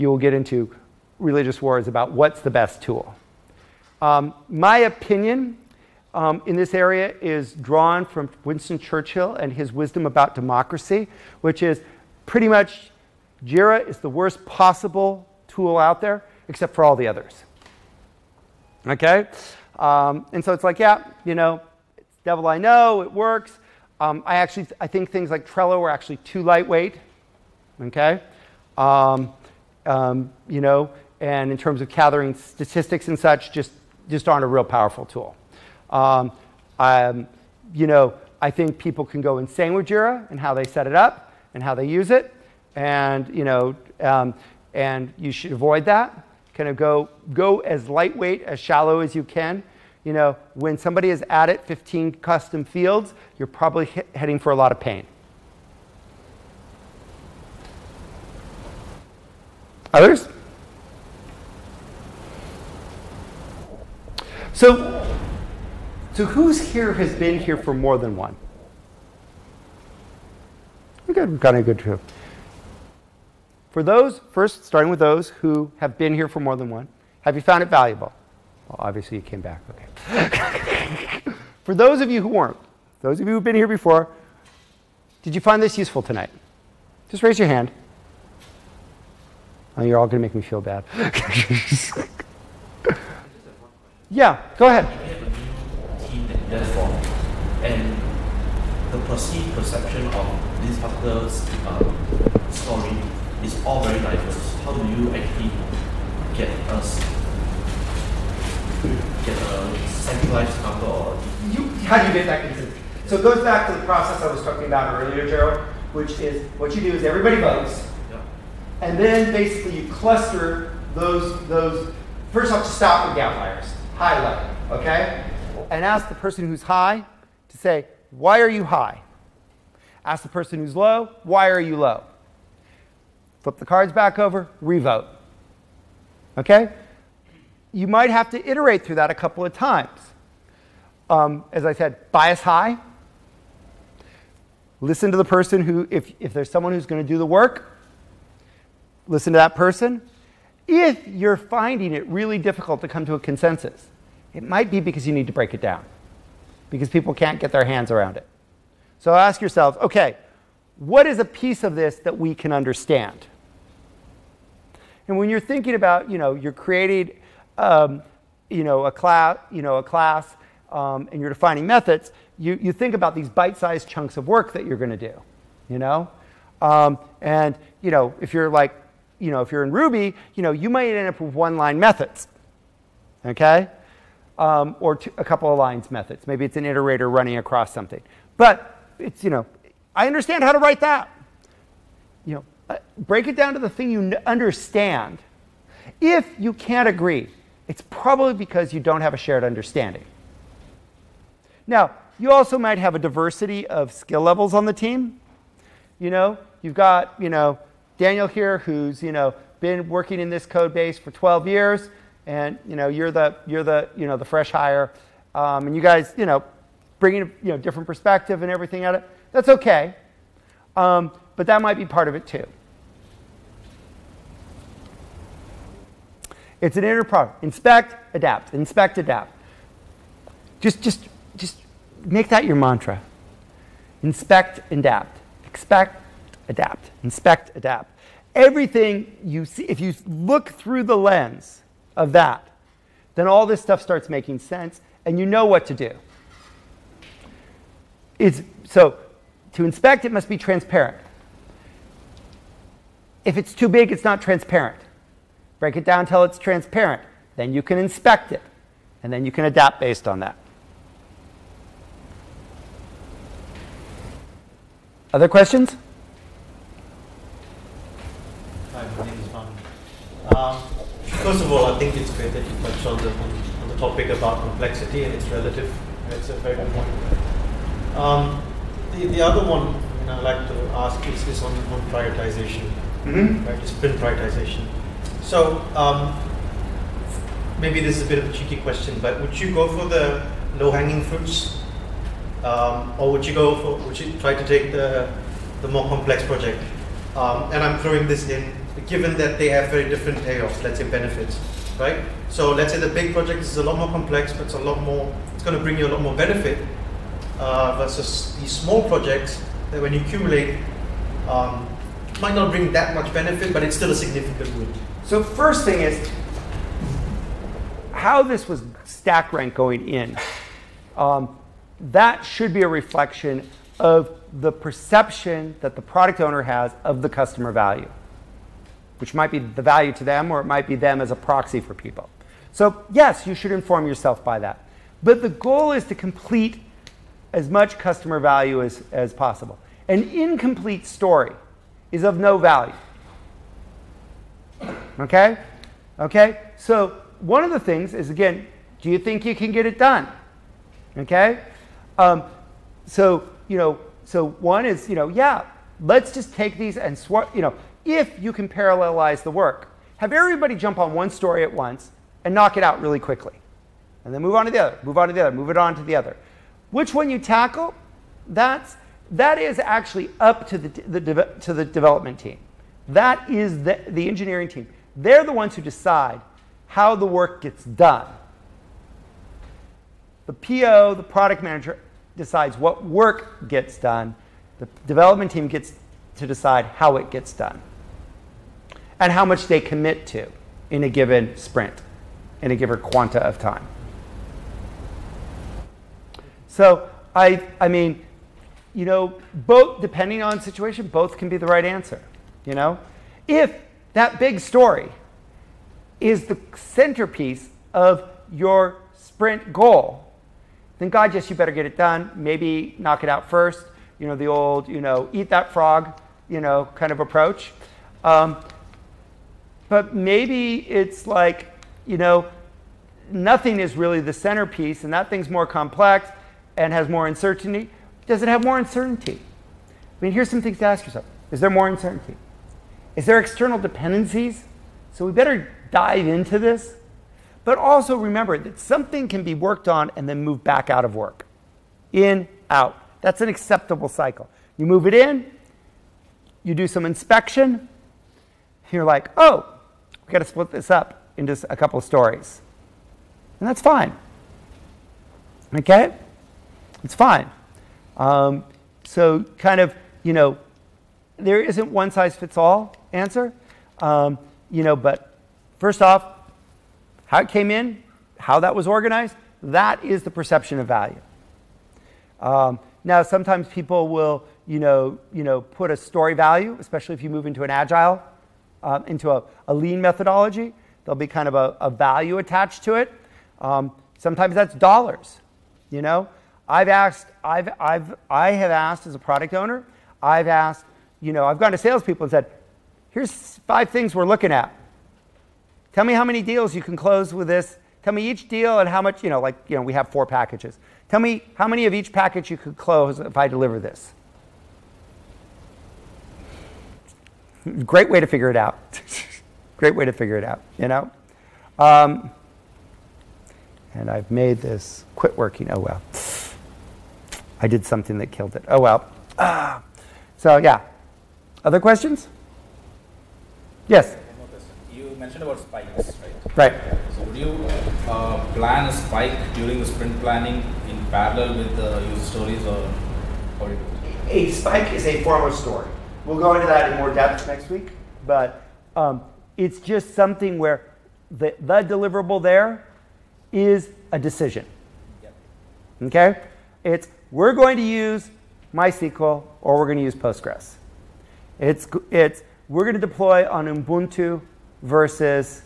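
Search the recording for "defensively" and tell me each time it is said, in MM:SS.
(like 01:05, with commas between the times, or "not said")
not said.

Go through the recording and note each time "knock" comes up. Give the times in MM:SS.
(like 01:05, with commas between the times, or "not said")
06:02, 06:52.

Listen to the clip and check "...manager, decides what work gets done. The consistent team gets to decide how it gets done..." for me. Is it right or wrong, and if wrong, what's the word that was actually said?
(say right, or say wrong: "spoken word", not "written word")
wrong: "development", not "consistent".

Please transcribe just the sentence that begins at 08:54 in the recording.
A spike is a form of story.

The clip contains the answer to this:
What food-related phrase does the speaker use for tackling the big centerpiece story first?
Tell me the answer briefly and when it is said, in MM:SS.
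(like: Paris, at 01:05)
Eat that frog, at 06:55.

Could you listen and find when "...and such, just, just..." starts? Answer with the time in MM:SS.
00:33.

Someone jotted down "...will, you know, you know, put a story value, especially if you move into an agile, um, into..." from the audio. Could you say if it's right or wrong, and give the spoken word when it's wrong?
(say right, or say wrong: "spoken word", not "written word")
right.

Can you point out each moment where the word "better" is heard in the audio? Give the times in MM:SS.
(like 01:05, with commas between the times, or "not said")
06:51, 07:15.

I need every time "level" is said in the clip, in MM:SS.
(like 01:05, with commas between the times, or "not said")
02:04, 03:24.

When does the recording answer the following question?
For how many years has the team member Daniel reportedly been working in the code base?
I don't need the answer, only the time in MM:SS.
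03:31.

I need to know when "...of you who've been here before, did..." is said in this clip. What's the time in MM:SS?
01:23.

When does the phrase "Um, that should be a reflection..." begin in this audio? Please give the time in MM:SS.
05:20.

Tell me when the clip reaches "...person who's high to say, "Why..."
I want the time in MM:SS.
02:06.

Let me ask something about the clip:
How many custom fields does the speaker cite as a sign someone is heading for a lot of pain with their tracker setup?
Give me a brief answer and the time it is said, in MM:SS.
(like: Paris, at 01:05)
15, at 00:51.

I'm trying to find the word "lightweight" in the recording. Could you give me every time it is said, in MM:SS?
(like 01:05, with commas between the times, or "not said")
00:26, 00:47.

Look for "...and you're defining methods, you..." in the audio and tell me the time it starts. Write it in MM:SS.
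02:51.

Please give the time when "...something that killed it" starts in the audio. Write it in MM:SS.
08:37.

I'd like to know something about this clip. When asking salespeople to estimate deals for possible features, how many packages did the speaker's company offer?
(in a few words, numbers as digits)
4.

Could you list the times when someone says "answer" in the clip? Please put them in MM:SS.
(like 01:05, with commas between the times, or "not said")
06:41, 07:42.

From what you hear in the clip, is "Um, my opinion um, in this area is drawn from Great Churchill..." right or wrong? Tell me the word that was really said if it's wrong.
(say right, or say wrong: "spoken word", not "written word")
wrong: "Winston", not "Great".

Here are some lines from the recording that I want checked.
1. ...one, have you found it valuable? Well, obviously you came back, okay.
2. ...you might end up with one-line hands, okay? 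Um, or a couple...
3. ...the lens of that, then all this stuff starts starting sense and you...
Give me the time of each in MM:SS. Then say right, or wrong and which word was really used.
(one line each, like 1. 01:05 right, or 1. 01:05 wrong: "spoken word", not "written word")
1. 01:16 right
2. 03:00 wrong: "methods", not "hands"
3. 04:00 wrong: "making", not "starting".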